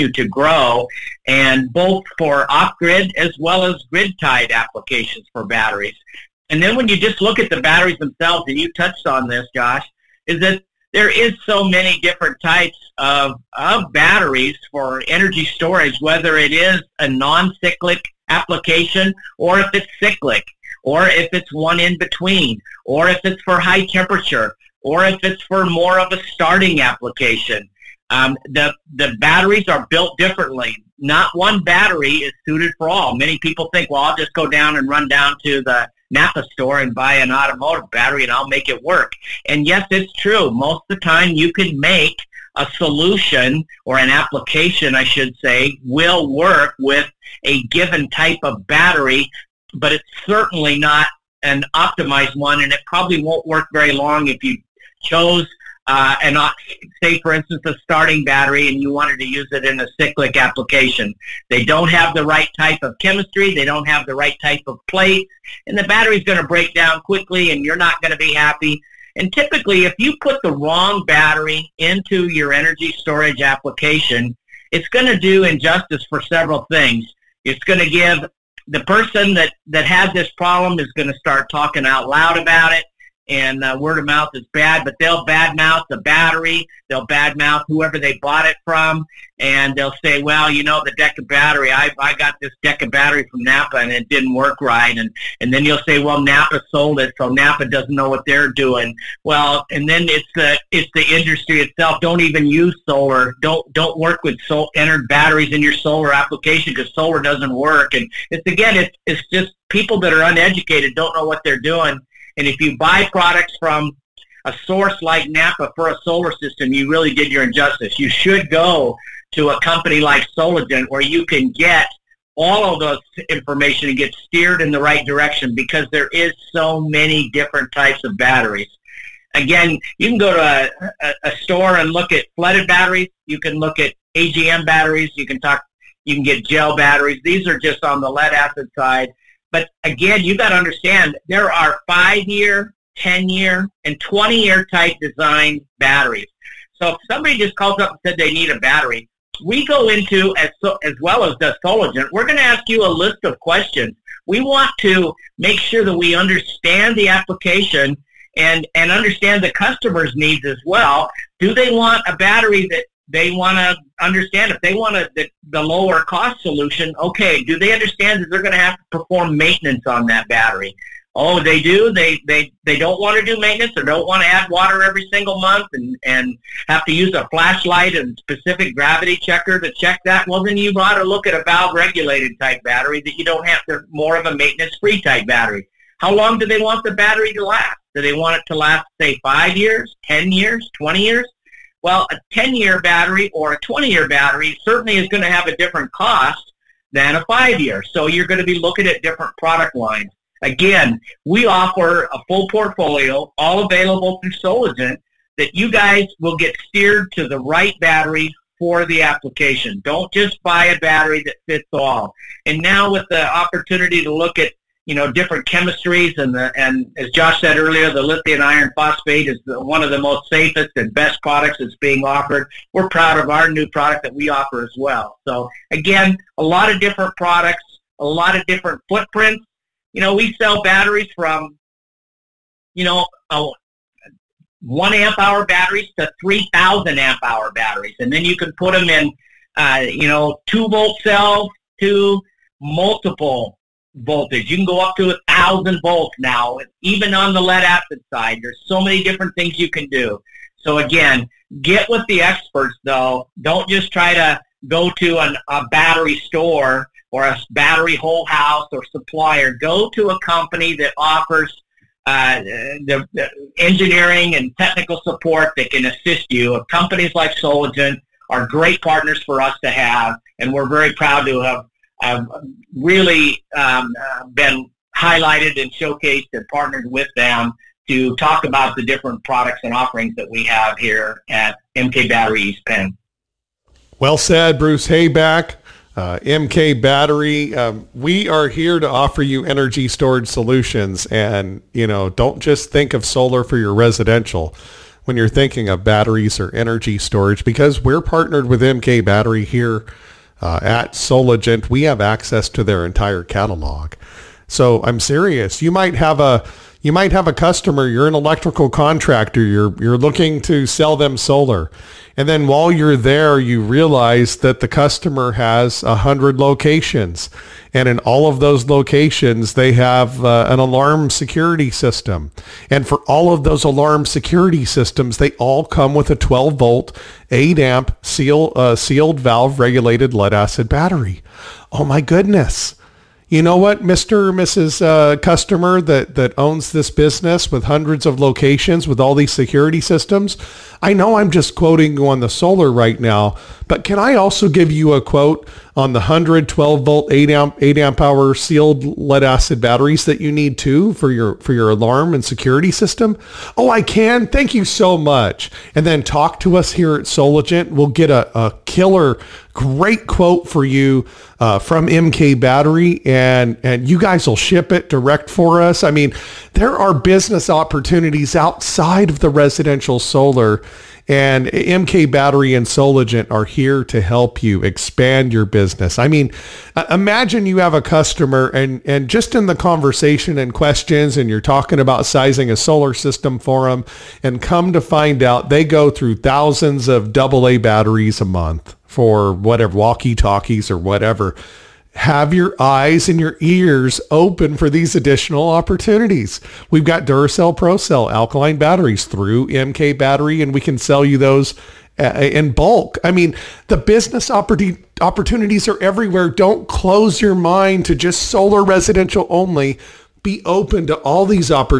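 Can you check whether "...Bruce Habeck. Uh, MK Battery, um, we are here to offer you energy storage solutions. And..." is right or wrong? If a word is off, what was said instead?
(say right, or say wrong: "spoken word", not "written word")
right.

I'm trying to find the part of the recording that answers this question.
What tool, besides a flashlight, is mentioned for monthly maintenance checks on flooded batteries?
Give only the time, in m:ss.
2:58.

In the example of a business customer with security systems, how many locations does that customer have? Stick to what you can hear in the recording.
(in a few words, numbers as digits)
100.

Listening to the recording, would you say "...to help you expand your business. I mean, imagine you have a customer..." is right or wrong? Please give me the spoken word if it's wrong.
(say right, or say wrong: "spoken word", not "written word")
right.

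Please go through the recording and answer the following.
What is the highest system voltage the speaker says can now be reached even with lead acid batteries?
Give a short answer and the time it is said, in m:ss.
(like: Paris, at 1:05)
1000 volts, at 4:05.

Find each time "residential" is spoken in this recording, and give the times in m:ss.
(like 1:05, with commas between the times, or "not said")
4:53, 6:09, 6:48.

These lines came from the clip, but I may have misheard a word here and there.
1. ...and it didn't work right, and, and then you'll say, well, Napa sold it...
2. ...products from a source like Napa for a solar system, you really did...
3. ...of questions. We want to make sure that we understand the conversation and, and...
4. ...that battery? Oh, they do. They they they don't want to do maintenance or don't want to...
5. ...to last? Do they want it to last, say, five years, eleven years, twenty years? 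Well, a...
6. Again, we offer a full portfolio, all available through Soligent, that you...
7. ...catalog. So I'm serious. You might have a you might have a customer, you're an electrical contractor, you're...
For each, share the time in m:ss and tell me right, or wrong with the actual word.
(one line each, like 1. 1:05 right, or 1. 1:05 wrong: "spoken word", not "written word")
1. 1:33 right
2. 1:53 right
3. 2:33 wrong: "application", not "conversation"
4. 2:50 right
5. 3:07 wrong: "ten", not "eleven"
6. 3:20 right
7. 5:03 right.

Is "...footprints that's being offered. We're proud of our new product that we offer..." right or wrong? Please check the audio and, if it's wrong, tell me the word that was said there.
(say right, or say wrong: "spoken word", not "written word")
wrong: "products", not "footprints".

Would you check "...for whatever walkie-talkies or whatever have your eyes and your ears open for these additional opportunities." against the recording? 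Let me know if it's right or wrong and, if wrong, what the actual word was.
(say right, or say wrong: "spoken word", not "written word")
right.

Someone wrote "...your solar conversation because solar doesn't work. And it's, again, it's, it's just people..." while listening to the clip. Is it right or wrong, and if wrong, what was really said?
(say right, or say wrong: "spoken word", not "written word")
wrong: "application", not "conversation".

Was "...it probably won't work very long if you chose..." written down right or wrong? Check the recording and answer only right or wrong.
right.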